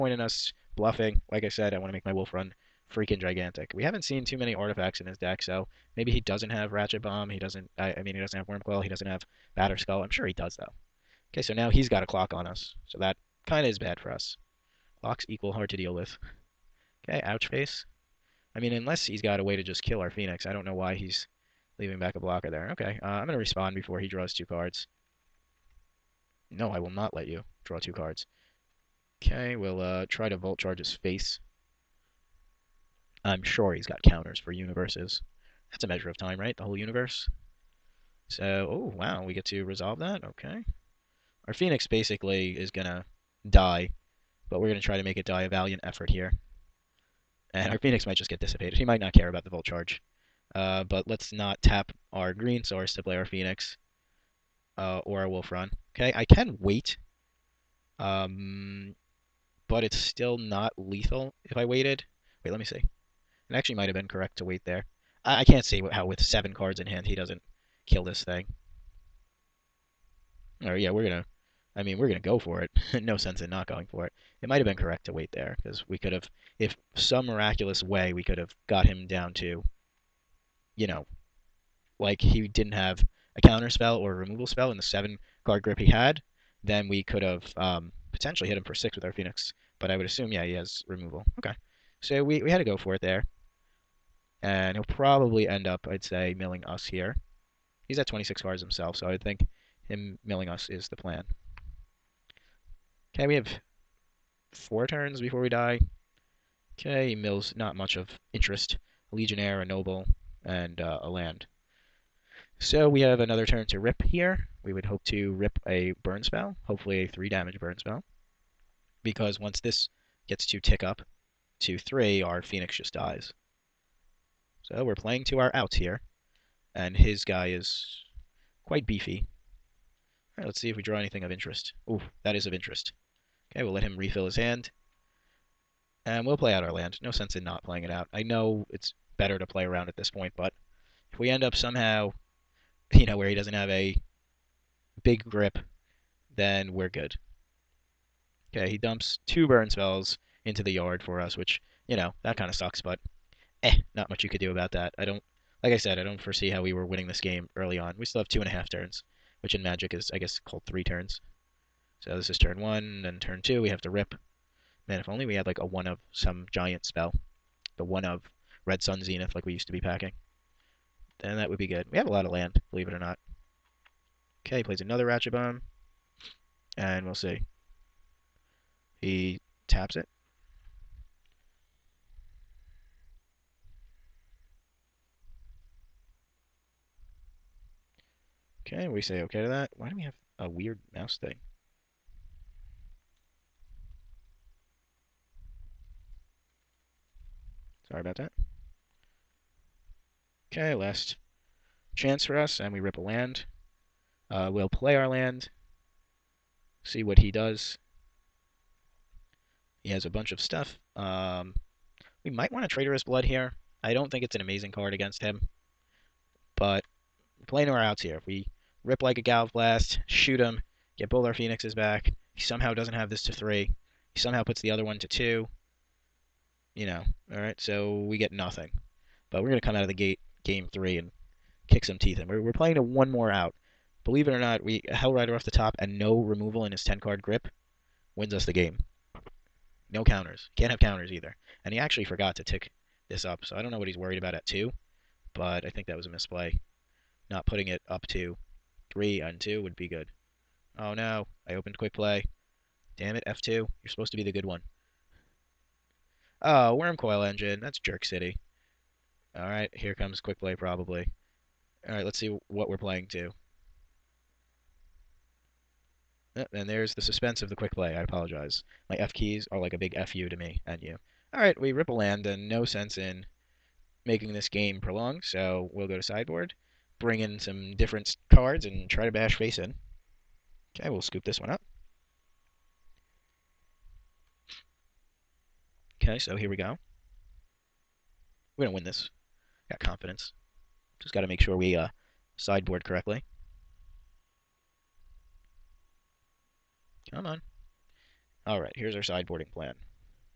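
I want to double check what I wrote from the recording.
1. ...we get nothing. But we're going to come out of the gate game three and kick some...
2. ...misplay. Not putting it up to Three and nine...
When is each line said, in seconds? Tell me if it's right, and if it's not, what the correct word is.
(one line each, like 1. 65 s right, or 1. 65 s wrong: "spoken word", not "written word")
1. 228 s right
2. 246 s wrong: "two", not "nine".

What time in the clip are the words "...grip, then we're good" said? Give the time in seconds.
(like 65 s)
145 s.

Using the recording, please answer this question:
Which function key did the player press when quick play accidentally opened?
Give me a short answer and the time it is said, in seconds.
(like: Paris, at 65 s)
F2, at 253 s.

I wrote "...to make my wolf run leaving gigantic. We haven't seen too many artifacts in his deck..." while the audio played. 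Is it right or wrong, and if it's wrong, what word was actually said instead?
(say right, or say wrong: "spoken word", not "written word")
wrong: "freaking", not "leaving".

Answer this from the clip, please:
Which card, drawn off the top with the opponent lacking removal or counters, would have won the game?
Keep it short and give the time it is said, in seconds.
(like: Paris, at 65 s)
Hellrider, at 234 s.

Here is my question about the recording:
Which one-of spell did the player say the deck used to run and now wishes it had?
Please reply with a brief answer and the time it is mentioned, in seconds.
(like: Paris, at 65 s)
Red Sun Zenith, at 168 s.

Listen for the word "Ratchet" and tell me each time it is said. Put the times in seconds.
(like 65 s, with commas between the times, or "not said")
6 s, 175 s.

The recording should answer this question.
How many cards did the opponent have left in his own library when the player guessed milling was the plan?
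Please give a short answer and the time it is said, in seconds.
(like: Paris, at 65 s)
26, at 98 s.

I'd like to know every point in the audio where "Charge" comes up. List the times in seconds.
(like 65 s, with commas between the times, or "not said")
30 s, 49 s.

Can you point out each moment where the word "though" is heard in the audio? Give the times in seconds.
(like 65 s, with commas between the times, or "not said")
10 s.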